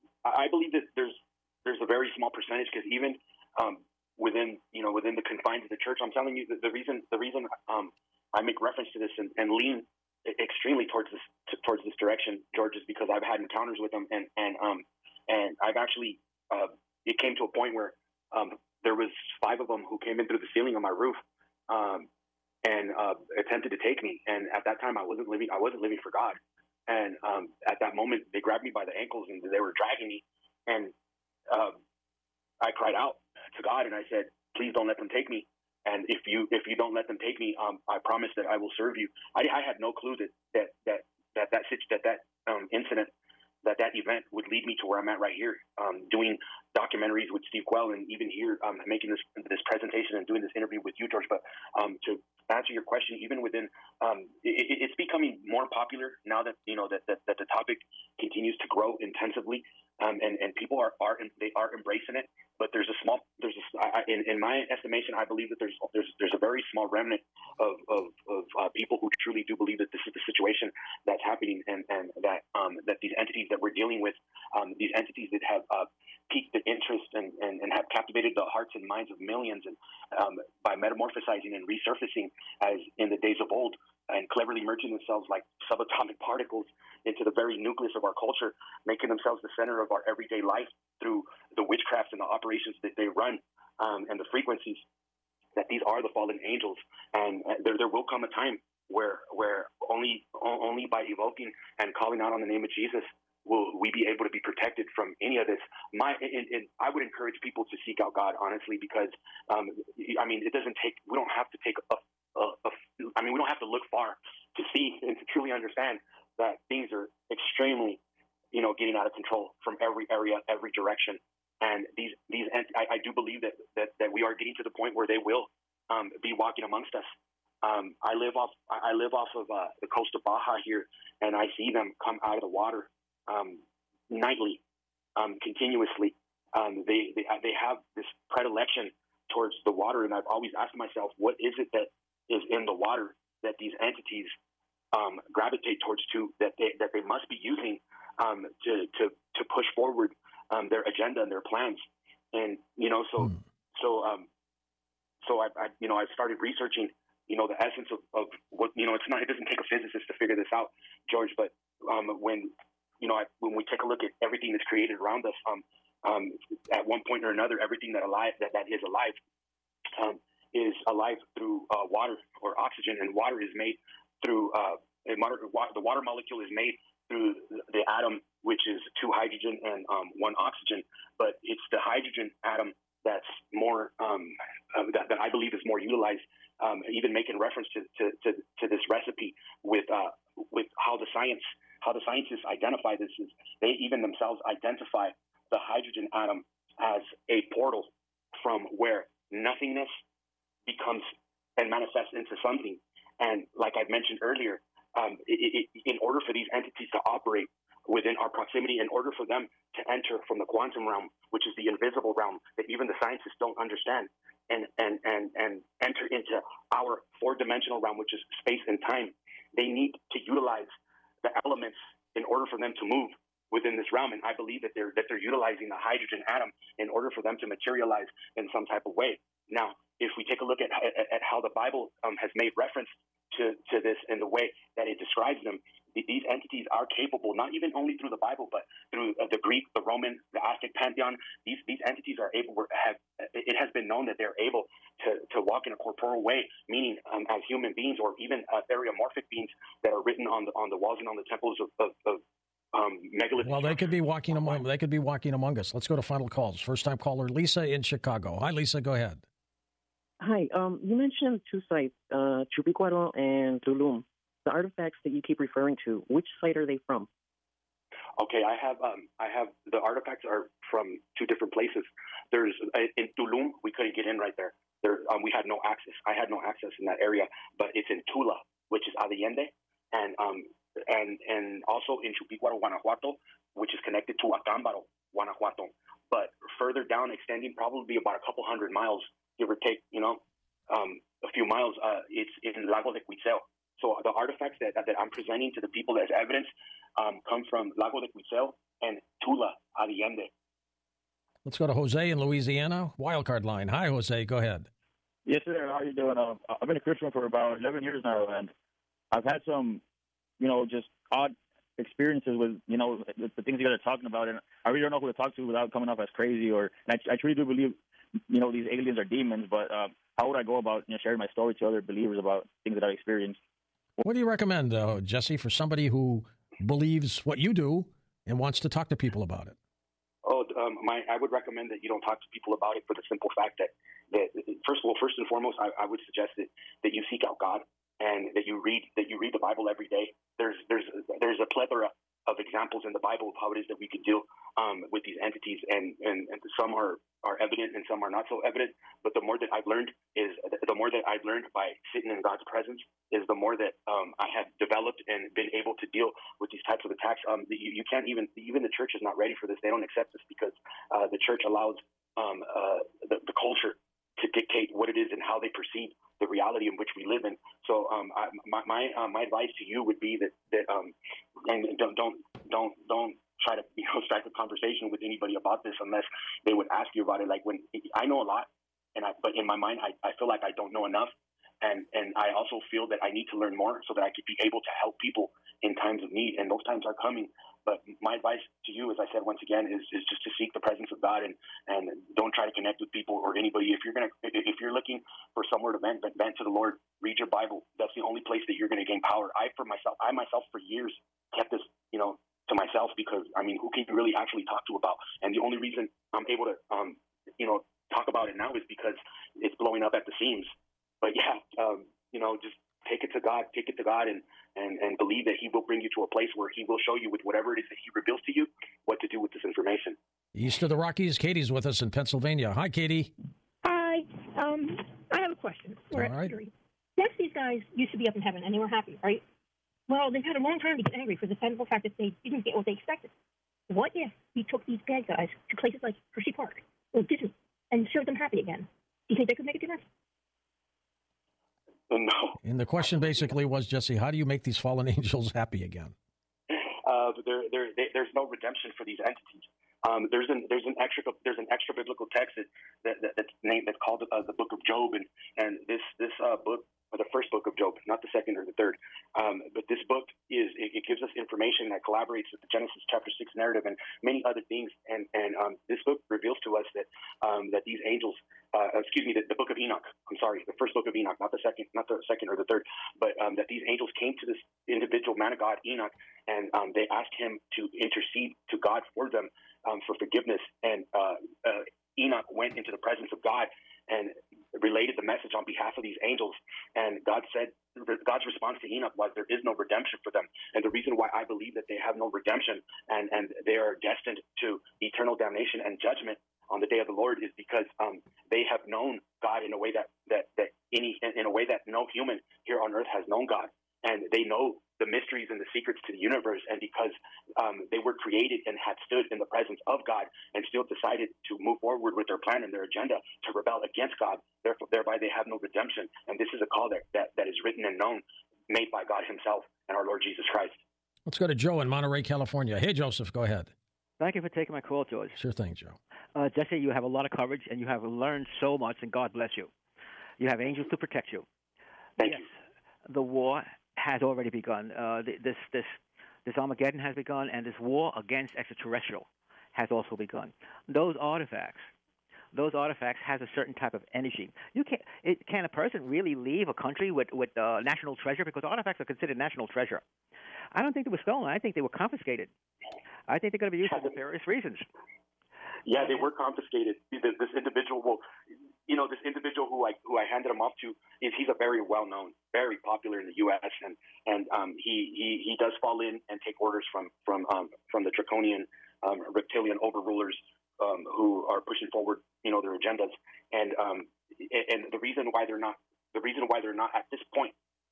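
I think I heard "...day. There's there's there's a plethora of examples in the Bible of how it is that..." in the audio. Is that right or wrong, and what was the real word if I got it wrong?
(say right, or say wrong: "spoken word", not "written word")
right.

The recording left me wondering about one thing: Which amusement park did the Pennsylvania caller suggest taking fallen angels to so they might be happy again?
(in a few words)
Hershey Park.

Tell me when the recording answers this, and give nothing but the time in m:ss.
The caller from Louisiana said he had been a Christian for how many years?
5:07.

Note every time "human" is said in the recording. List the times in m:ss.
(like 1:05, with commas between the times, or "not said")
4:07, 8:21.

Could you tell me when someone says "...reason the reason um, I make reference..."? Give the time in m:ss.
0:06.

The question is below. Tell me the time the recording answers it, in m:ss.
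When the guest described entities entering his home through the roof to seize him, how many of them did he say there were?
0:19.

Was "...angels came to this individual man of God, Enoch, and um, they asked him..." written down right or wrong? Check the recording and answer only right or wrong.
right.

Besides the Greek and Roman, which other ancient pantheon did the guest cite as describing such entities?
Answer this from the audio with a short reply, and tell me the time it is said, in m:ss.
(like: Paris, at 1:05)
Aztec, at 4:00.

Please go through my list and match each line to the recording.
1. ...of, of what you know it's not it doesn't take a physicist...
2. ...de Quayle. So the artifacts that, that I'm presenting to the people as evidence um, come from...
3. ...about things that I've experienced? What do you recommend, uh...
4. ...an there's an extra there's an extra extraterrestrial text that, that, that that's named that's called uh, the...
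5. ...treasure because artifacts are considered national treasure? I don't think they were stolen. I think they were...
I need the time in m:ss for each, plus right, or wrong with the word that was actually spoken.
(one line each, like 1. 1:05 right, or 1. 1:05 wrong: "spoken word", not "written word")
1. 2:37 right
2. 4:52 wrong: "Cuitzeo", not "Quayle"
3. 5:22 right
4. 7:30 wrong: "biblical", not "extraterrestrial"
5. 9:08 right.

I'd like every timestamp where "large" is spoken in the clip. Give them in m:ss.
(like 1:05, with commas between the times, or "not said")
not said.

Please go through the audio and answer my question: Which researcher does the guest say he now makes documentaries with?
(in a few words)
Steve Quayle.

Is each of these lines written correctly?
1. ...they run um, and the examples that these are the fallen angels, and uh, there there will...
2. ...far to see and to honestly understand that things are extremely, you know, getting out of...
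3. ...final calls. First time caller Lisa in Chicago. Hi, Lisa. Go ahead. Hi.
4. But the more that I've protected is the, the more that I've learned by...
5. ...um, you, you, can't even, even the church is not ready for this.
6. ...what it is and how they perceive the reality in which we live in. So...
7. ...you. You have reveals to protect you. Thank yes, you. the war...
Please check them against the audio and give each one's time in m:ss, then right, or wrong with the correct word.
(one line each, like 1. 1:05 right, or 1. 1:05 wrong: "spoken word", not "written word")
1. 1:32 wrong: "frequencies", not "examples"
2. 1:53 wrong: "truly", not "honestly"
3. 4:16 right
4. 5:49 wrong: "learned", not "protected"
5. 5:57 right
6. 6:04 right
7. 8:49 wrong: "angels", not "reveals".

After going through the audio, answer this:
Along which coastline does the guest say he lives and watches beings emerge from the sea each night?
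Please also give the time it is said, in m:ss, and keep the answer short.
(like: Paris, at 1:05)
Baja, at 2:10.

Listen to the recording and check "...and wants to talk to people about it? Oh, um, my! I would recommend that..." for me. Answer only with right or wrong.
right.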